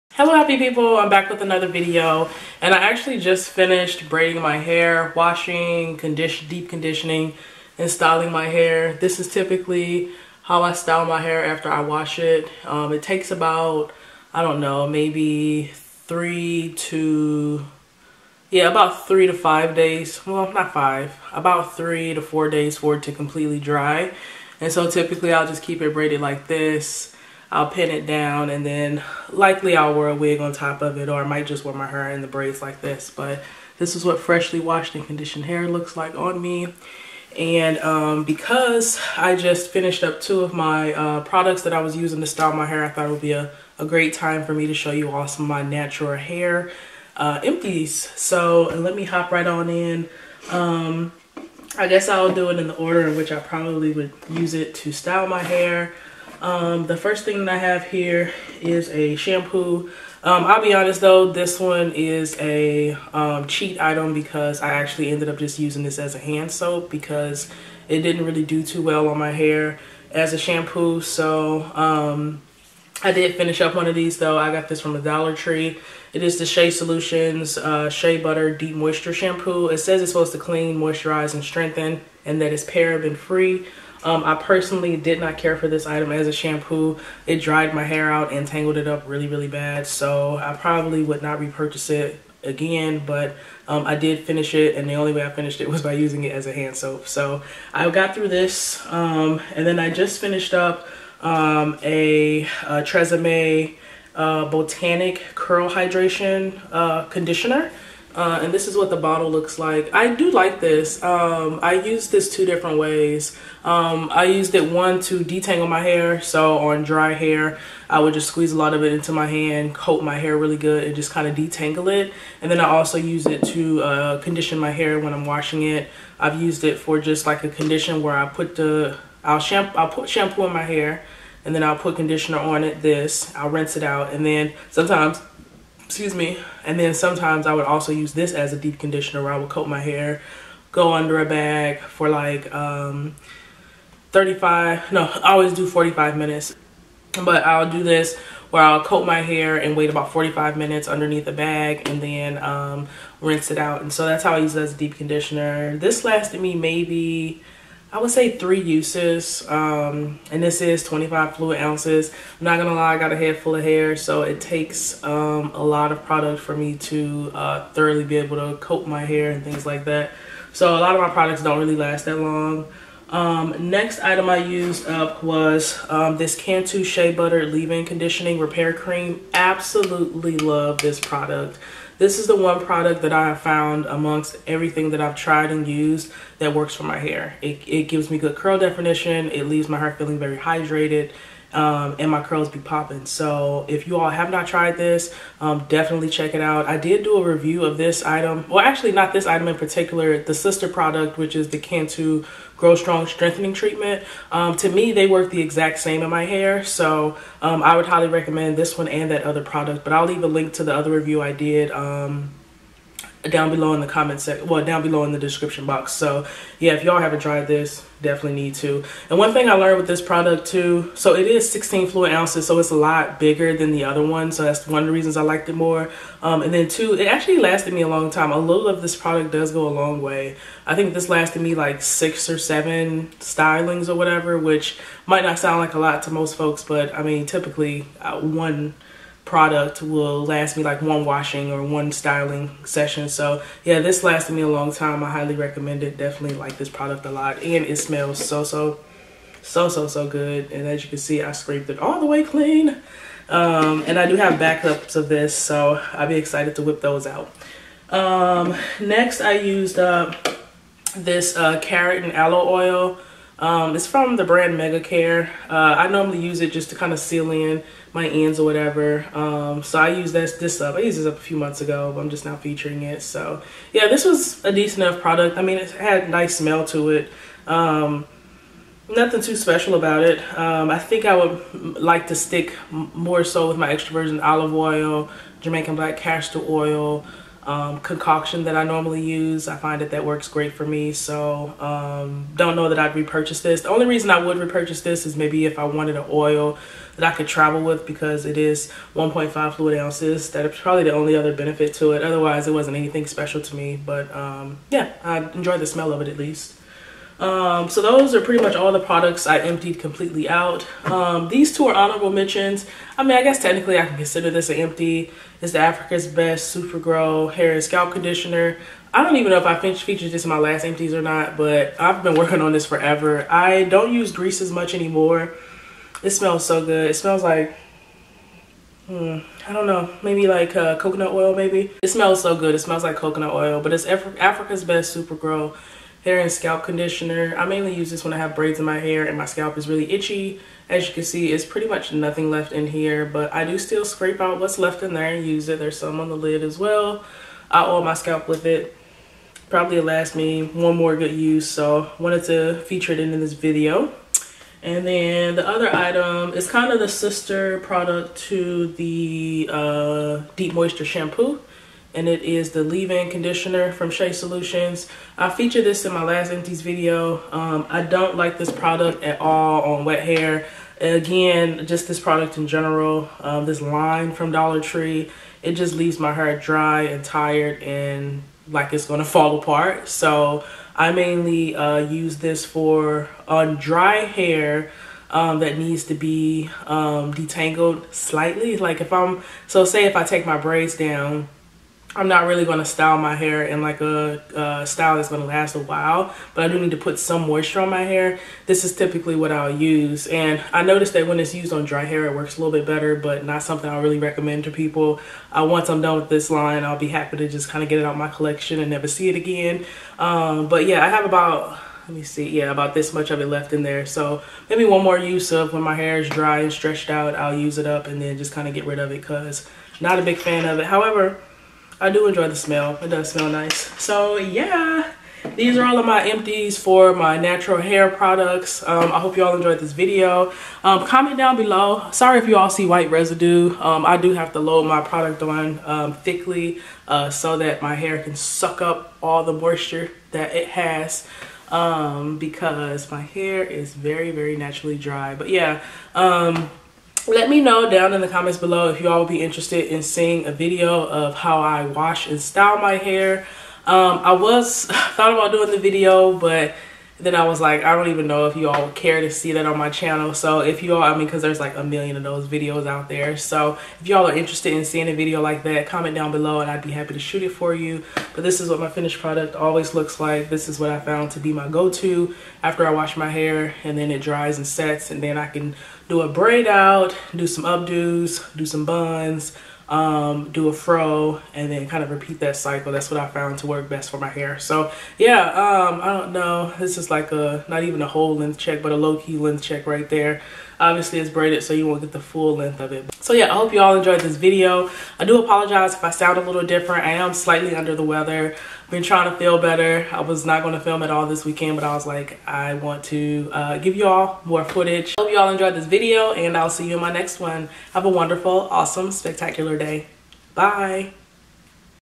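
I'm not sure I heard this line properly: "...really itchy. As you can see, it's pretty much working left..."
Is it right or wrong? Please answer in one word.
wrong.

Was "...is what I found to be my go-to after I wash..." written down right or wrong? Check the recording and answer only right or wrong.
right.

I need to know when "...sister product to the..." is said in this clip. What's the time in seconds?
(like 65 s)
356 s.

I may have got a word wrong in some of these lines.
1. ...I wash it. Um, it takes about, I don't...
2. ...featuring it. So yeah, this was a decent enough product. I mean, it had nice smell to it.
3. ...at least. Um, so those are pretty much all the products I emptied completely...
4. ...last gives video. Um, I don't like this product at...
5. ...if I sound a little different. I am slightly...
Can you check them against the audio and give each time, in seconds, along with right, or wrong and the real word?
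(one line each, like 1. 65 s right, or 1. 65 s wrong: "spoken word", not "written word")
1. 11 s right
2. 272 s right
3. 306 s right
4. 366 s wrong: "empties", not "gives"
5. 495 s right.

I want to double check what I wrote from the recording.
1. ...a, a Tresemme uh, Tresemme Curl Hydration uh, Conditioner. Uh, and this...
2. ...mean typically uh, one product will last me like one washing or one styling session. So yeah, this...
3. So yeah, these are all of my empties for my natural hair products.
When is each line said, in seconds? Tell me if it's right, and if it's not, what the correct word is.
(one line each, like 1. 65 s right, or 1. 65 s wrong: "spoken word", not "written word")
1. 101 s wrong: "Botanic", not "Tresemme"
2. 237 s right
3. 423 s right.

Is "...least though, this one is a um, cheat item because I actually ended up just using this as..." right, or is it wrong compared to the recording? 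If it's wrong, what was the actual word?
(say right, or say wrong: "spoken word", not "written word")
wrong: "honest", not "least".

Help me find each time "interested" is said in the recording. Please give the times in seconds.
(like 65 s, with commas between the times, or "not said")
449 s, 464 s.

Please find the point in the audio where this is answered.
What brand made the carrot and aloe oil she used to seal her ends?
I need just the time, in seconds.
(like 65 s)
264 s.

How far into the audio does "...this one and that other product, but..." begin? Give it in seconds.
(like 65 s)
208 s.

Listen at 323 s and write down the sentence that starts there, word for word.
I don't use grease as much anymore.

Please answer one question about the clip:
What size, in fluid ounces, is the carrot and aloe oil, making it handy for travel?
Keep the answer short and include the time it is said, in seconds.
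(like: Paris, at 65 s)
1.5, at 298 s.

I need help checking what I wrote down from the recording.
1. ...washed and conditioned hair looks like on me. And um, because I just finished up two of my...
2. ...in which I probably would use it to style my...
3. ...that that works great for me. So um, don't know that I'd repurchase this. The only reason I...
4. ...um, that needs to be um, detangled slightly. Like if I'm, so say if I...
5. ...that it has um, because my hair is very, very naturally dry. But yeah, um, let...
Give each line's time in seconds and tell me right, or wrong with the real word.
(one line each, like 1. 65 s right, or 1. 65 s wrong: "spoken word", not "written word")
1. 34 s right
2. 53 s right
3. 289 s right
4. 385 s right
5. 440 s right.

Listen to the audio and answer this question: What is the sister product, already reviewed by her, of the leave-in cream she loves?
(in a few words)
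Cantu Grow Strong Strengthening Treatment.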